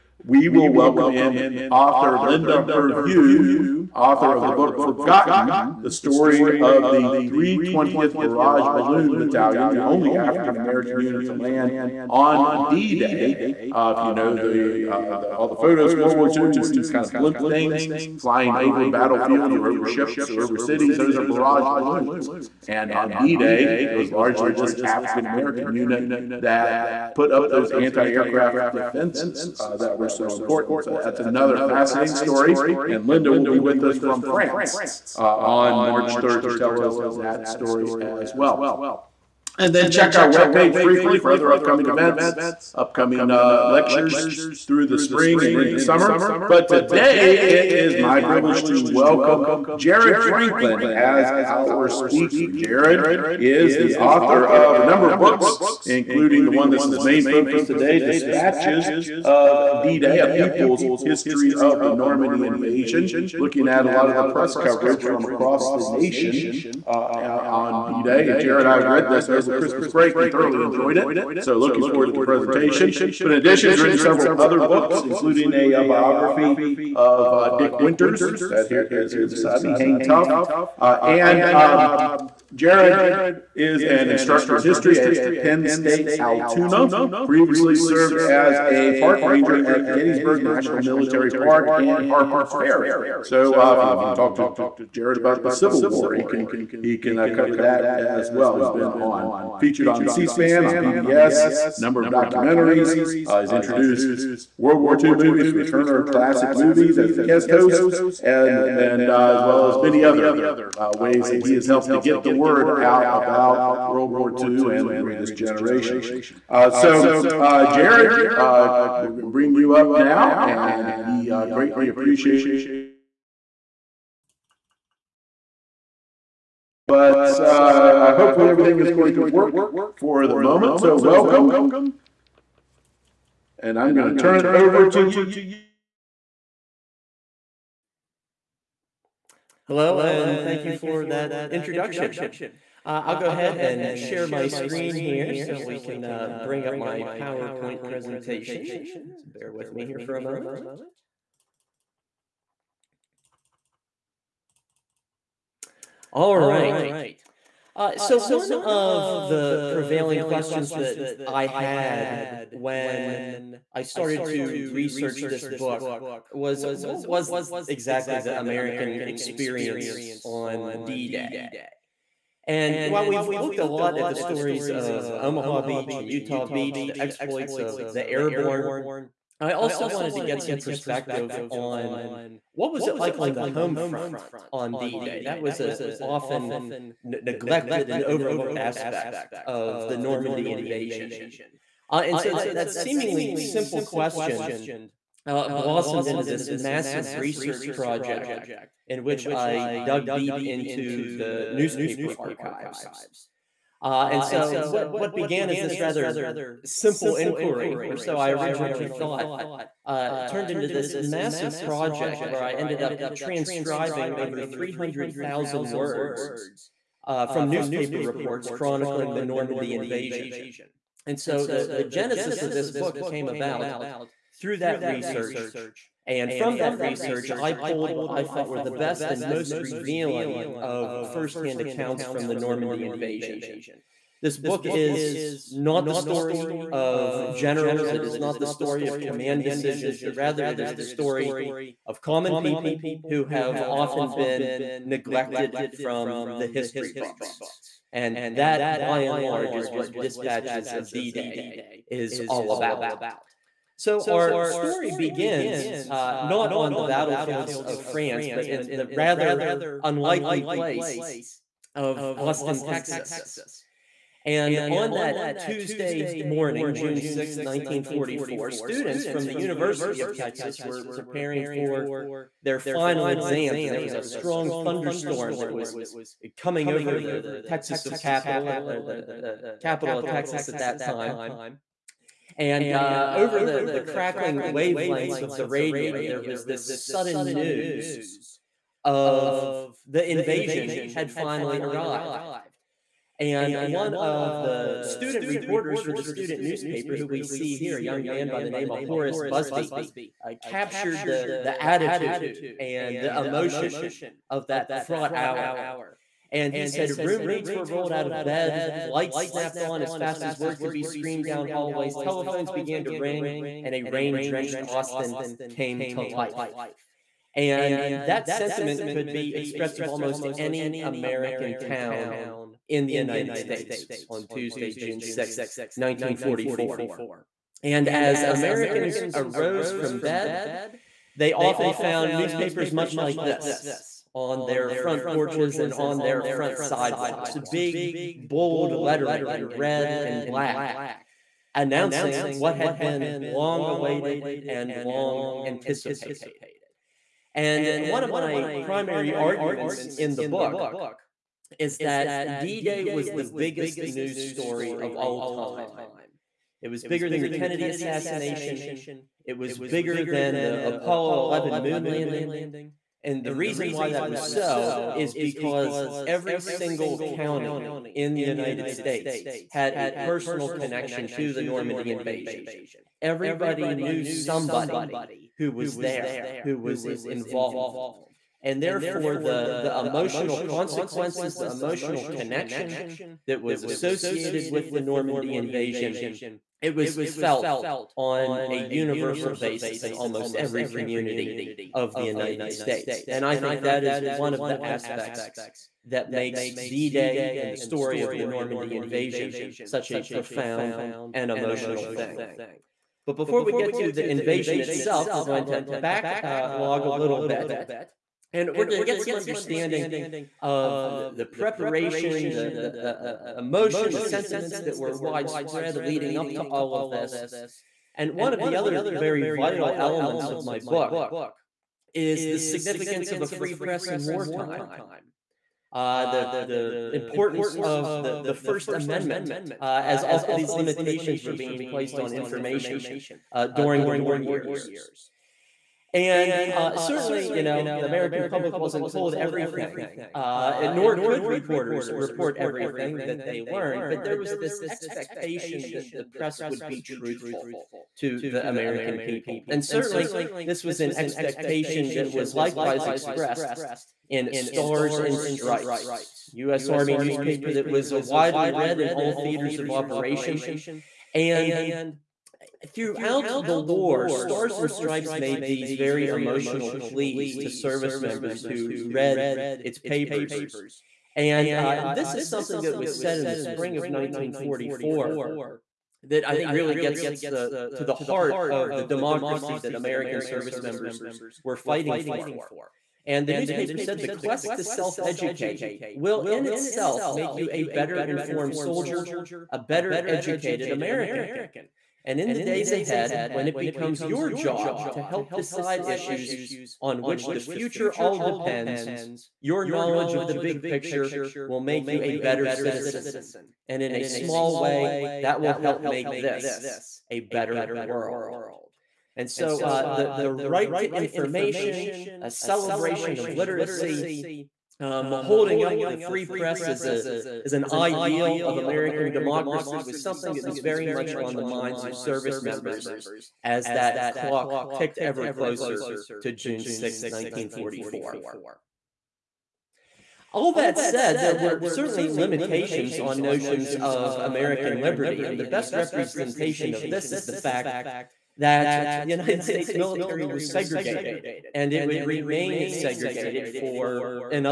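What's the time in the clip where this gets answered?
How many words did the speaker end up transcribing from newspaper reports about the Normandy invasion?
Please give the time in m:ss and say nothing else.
3:34.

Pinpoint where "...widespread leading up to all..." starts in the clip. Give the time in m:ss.
6:54.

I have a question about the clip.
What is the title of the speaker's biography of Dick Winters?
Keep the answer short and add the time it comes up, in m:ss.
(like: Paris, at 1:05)
Hang Tough, at 1:19.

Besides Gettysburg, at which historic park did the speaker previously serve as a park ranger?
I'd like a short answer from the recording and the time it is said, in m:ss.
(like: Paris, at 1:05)
Harper's Ferry, at 1:32.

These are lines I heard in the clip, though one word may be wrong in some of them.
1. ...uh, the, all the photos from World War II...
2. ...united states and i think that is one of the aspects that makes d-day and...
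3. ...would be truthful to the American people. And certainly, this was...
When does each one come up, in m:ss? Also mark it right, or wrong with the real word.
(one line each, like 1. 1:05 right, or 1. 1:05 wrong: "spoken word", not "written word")
1. 0:14 right
2. 6:32 right
3. 7:26 right.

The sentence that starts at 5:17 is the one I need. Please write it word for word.
And that sentiment could be expressed of almost any American town in the United States on Tuesday, June 6th, 1944.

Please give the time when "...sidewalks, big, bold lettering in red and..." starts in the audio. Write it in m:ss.
5:36.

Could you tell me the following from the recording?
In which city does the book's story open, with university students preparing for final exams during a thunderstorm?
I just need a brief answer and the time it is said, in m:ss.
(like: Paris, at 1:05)
Austin, Texas, at 4:22.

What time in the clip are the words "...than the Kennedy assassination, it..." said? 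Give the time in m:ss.
5:57.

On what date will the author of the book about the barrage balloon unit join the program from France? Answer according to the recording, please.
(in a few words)
March 3rd.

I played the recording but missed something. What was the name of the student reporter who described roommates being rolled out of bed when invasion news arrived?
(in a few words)
Horace Busby.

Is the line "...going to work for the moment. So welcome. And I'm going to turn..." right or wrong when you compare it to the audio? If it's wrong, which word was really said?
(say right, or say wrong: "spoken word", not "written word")
right.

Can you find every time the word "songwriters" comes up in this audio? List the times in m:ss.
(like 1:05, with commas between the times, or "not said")
not said.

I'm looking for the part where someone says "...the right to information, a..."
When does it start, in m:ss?
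8:30.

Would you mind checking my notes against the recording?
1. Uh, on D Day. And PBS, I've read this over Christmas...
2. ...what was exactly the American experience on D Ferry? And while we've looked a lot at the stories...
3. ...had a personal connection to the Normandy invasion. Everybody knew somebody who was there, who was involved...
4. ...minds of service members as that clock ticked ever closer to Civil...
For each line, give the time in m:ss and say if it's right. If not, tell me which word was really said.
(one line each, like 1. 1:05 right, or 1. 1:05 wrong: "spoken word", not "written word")
1. 1:06 wrong: "Jared", not "PBS"
2. 2:46 wrong: "Day", not "Ferry"
3. 6:09 right
4. 8:41 wrong: "June", not "Civil".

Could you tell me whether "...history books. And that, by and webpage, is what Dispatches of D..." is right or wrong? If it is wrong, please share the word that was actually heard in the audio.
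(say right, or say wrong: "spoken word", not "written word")
wrong: "large", not "webpage".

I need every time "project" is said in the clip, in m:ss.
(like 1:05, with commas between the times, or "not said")
3:17, 3:31.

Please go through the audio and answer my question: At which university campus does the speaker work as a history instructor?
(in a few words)
Penn State Altoona.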